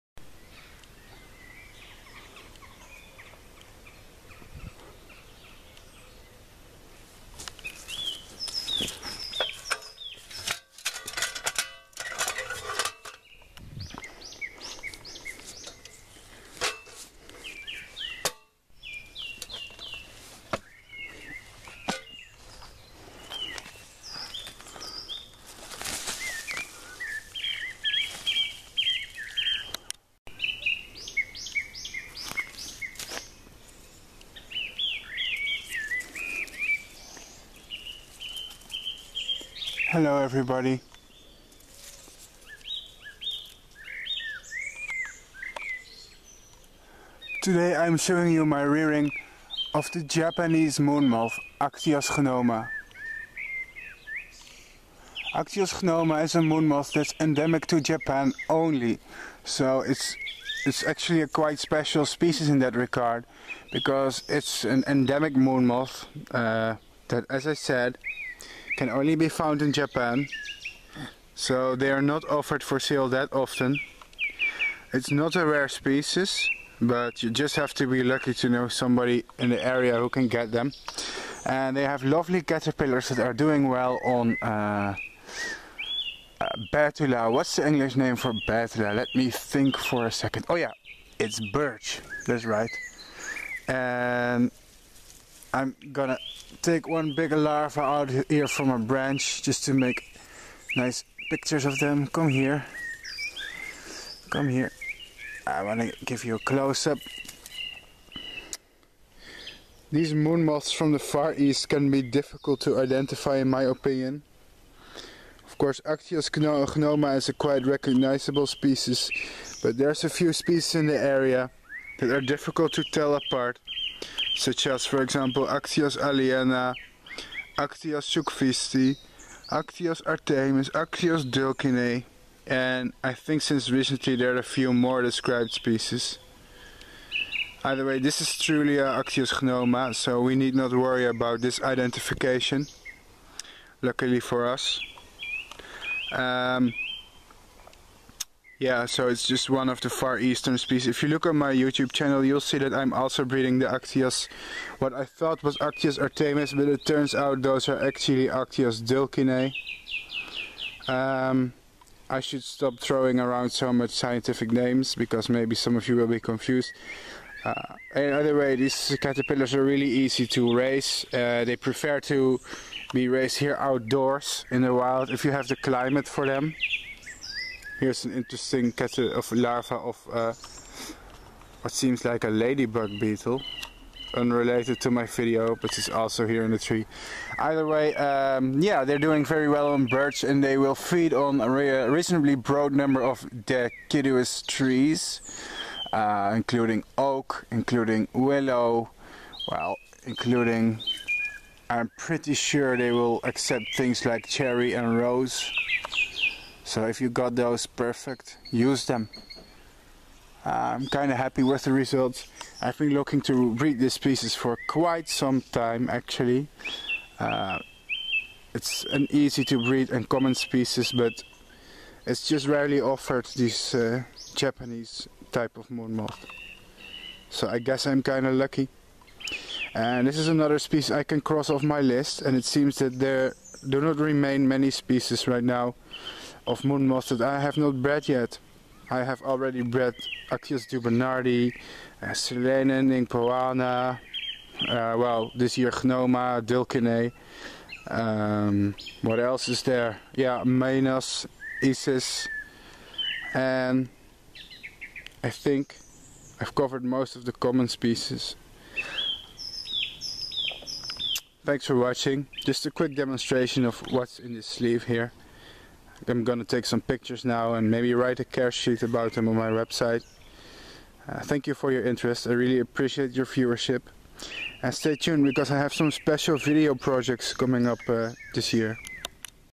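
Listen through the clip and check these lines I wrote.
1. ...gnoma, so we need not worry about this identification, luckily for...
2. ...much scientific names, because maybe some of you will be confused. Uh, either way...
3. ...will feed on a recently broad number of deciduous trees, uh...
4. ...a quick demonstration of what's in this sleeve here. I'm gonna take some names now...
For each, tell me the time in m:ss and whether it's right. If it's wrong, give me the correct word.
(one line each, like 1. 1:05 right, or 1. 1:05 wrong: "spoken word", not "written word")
1. 2:19 right
2. 2:43 right
3. 3:10 wrong: "reasonably", not "recently"
4. 4:22 wrong: "pictures", not "names".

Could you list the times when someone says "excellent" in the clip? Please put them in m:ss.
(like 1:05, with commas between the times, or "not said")
not said.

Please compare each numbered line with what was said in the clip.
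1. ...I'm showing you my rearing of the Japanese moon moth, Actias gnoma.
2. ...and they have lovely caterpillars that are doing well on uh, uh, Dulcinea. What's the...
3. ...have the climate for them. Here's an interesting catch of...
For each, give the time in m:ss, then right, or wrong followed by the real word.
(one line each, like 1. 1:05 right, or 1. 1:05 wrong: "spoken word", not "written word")
1. 0:47 right
2. 1:21 wrong: "Betula", not "Dulcinea"
3. 2:55 right.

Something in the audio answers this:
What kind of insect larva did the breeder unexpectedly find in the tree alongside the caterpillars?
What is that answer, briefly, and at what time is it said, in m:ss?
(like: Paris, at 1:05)
Ladybug beetle, at 3:02.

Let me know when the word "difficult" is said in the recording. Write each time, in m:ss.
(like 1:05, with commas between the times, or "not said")
1:52, 2:02.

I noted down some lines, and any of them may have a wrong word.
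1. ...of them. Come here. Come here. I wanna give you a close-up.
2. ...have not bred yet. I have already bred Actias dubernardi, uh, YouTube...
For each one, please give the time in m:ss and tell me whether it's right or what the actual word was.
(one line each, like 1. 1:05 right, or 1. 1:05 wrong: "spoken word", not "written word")
1. 1:41 right
2. 3:57 wrong: "Selene", not "YouTube".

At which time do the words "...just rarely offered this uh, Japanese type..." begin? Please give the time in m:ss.
3:42.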